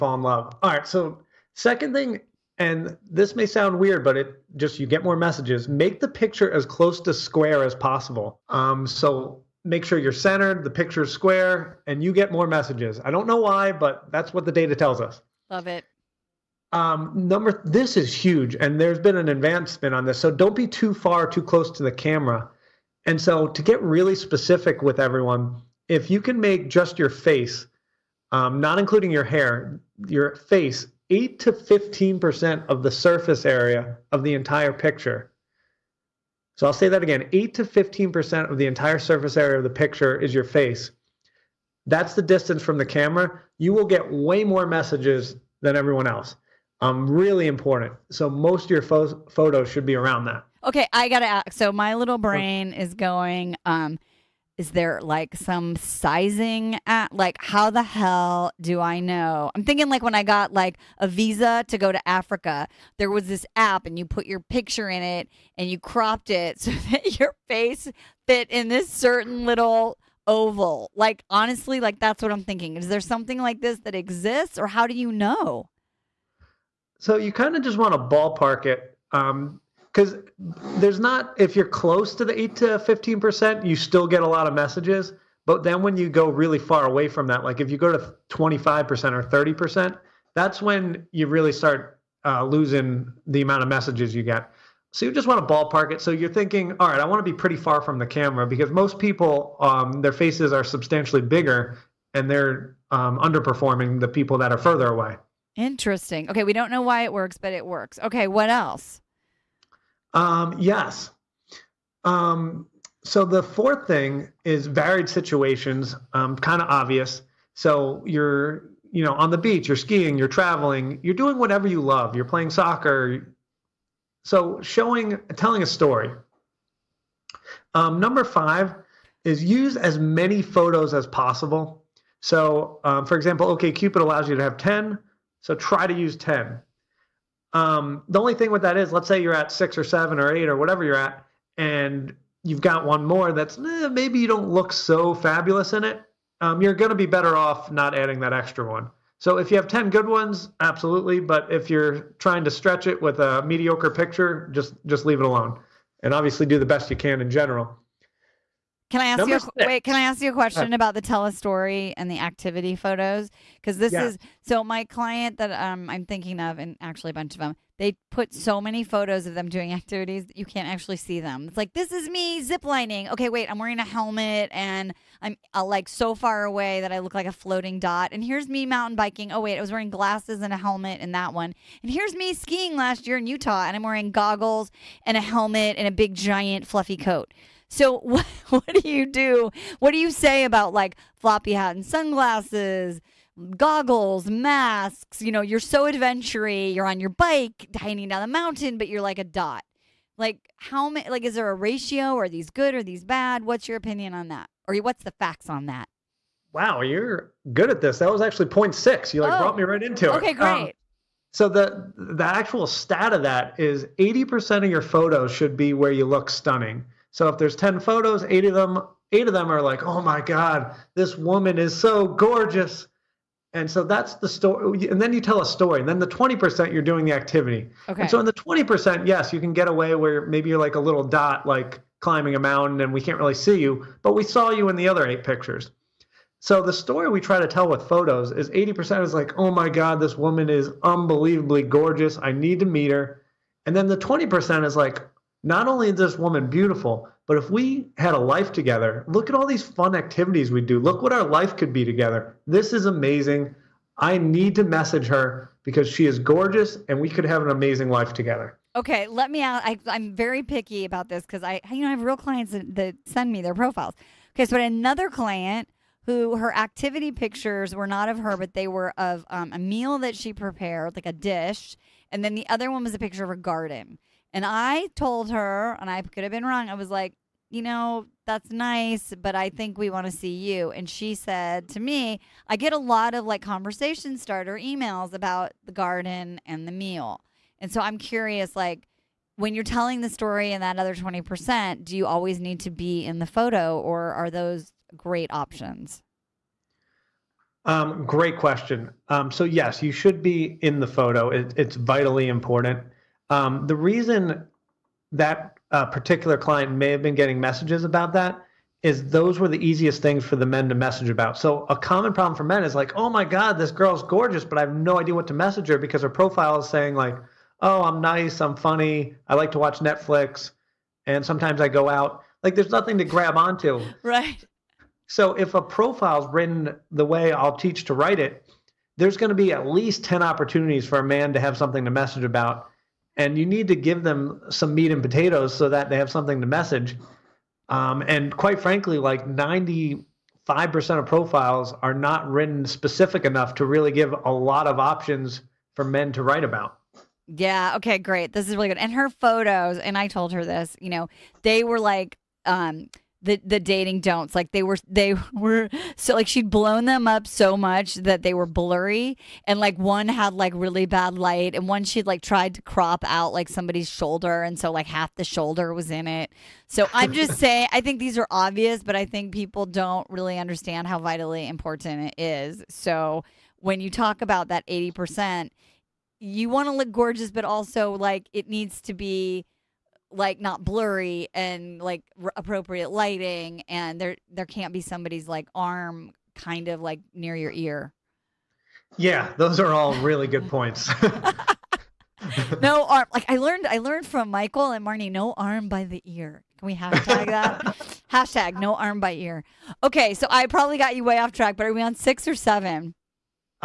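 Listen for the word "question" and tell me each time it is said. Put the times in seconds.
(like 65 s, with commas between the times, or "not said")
160 s, 298 s.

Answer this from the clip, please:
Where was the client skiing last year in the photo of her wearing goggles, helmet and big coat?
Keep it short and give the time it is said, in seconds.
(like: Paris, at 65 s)
Utah, at 183 s.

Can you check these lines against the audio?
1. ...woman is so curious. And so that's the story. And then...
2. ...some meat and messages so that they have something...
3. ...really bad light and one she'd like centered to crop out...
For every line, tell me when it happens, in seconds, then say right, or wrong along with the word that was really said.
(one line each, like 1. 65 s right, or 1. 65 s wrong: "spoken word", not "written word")
1. 221 s wrong: "gorgeous", not "curious"
2. 334 s wrong: "potatoes", not "messages"
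3. 360 s wrong: "tried", not "centered".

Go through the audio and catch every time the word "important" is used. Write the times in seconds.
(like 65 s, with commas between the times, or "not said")
47 s, 302 s, 371 s.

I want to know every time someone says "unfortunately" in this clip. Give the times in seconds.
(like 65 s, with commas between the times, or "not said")
not said.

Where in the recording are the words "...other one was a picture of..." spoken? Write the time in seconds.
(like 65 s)
272 s.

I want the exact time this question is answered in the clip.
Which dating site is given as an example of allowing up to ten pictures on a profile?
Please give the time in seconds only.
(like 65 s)
133 s.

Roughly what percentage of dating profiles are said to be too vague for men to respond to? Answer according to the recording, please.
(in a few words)
95%.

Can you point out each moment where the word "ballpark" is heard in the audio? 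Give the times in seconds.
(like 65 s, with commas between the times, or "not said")
78 s, 95 s.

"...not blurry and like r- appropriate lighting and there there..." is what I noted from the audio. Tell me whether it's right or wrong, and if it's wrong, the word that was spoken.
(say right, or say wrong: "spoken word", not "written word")
right.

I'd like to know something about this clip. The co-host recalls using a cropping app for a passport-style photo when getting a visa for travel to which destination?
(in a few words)
Africa.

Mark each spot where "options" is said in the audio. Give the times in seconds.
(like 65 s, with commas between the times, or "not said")
295 s, 344 s.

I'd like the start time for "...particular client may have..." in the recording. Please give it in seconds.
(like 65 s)
305 s.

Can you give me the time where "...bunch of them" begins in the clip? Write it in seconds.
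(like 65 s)
167 s.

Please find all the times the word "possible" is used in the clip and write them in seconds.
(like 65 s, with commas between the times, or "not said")
7 s, 131 s.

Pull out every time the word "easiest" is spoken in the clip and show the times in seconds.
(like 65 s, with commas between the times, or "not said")
309 s.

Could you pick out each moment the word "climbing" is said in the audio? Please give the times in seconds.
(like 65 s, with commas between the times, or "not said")
231 s.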